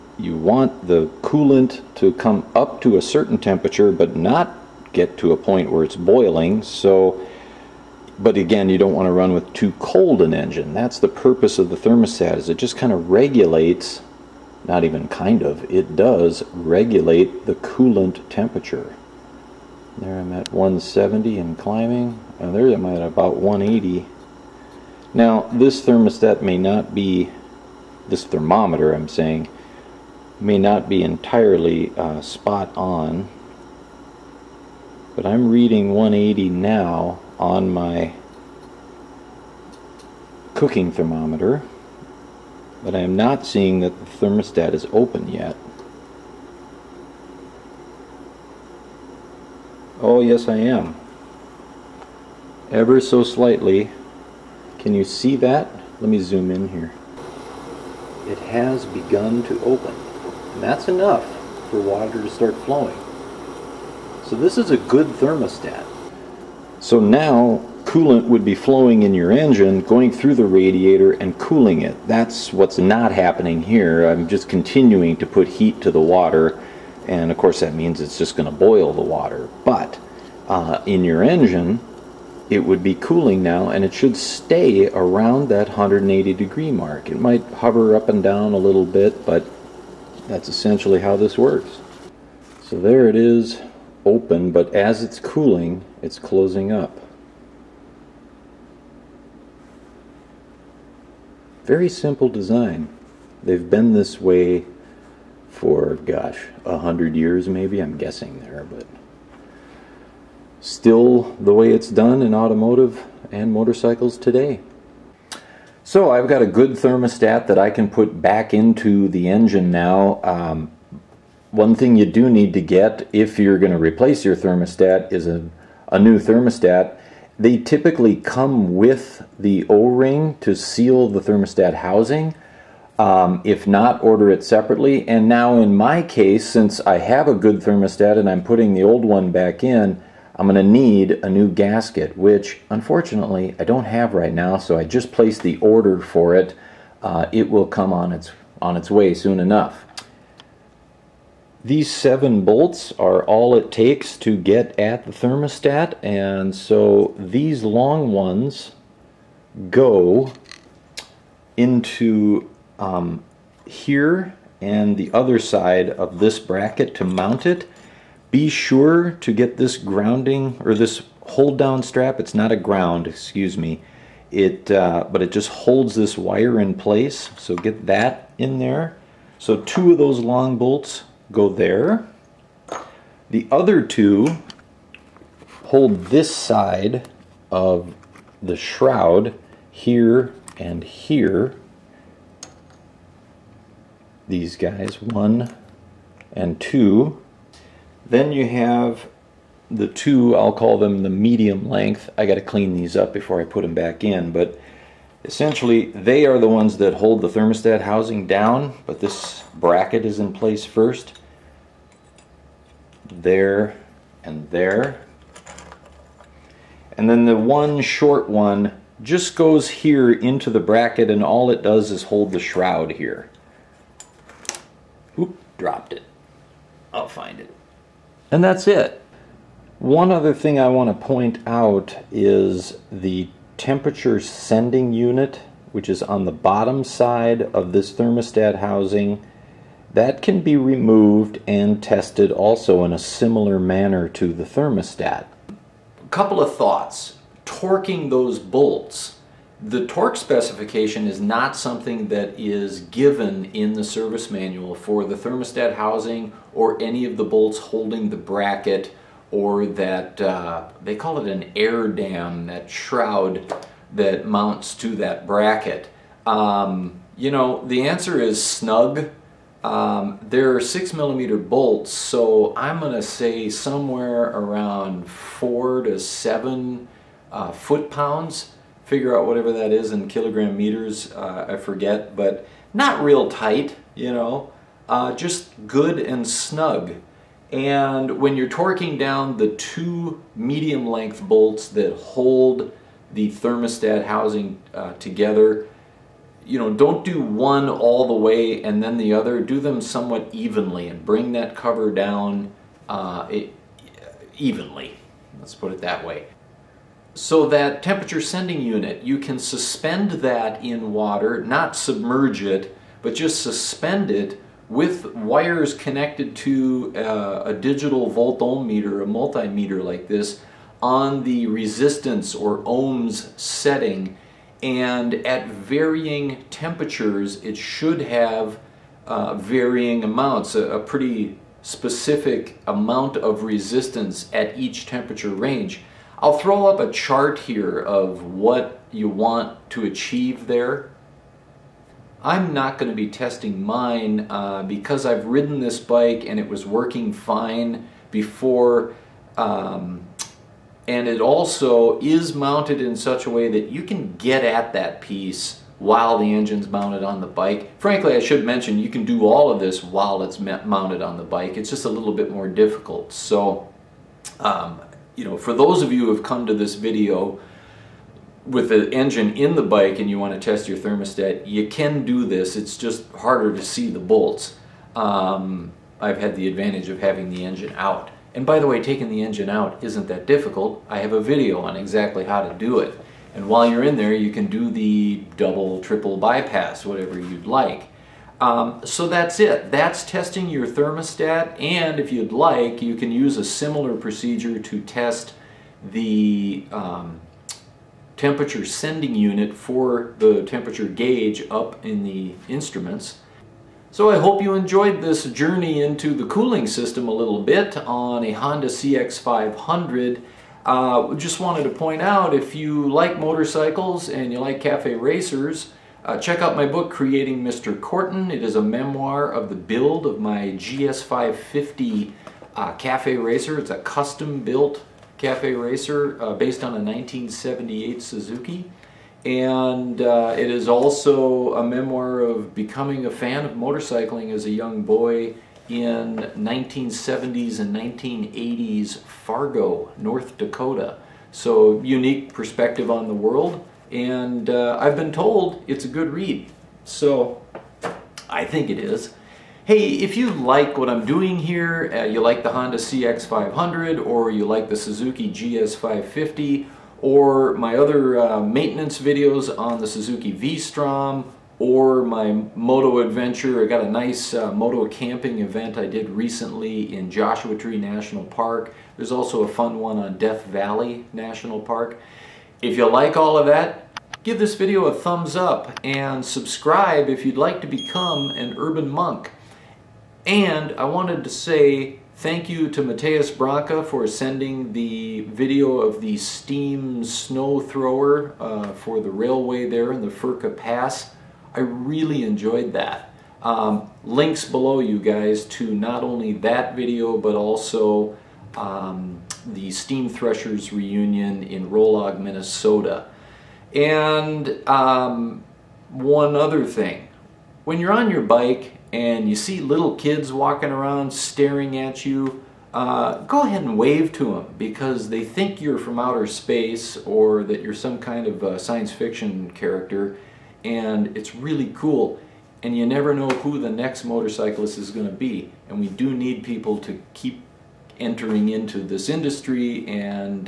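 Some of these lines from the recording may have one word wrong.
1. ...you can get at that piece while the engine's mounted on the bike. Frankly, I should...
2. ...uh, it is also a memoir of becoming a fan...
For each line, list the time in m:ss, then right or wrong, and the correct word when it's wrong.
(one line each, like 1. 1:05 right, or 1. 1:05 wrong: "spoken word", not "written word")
1. 5:53 right
2. 7:10 right.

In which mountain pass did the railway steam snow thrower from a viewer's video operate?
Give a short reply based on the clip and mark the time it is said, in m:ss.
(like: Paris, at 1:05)
Furka Pass, at 8:10.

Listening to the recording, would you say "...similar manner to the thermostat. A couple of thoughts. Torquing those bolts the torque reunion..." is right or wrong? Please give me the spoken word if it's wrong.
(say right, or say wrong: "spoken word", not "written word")
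wrong: "specification", not "reunion".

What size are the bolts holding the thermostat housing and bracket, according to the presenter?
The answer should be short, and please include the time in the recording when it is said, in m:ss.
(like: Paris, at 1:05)
6 millimeter, at 4:30.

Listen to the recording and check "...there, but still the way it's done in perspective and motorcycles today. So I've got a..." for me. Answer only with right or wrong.
wrong.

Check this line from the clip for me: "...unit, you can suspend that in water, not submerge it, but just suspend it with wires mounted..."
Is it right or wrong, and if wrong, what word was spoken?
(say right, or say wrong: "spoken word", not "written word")
wrong: "connected", not "mounted".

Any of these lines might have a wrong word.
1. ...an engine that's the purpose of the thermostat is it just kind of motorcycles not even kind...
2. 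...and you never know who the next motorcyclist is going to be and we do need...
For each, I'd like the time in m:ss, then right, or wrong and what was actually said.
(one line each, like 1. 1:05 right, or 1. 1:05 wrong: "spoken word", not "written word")
1. 0:10 wrong: "regulates", not "motorcycles"
2. 8:42 right.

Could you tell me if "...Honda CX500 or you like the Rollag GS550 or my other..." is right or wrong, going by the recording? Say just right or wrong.
wrong.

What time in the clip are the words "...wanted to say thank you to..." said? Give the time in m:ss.
8:00.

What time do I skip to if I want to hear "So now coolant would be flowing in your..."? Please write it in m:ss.
1:06.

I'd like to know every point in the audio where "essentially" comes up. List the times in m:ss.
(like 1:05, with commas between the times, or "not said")
1:30, 3:25.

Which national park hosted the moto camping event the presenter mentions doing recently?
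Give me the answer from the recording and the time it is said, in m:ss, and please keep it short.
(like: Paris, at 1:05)
Joshua Tree, at 7:47.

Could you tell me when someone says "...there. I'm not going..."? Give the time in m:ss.
5:40.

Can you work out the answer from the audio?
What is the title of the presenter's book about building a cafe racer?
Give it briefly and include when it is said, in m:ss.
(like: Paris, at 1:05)
Creating Mr. Kortan, at 6:56.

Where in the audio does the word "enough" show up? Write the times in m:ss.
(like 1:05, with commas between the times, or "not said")
1:00, 2:29.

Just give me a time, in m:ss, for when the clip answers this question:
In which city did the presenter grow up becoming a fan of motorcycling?
7:19.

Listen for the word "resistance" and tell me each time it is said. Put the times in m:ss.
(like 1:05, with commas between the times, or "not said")
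5:21, 5:33.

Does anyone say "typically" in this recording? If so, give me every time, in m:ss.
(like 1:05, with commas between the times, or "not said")
2:07.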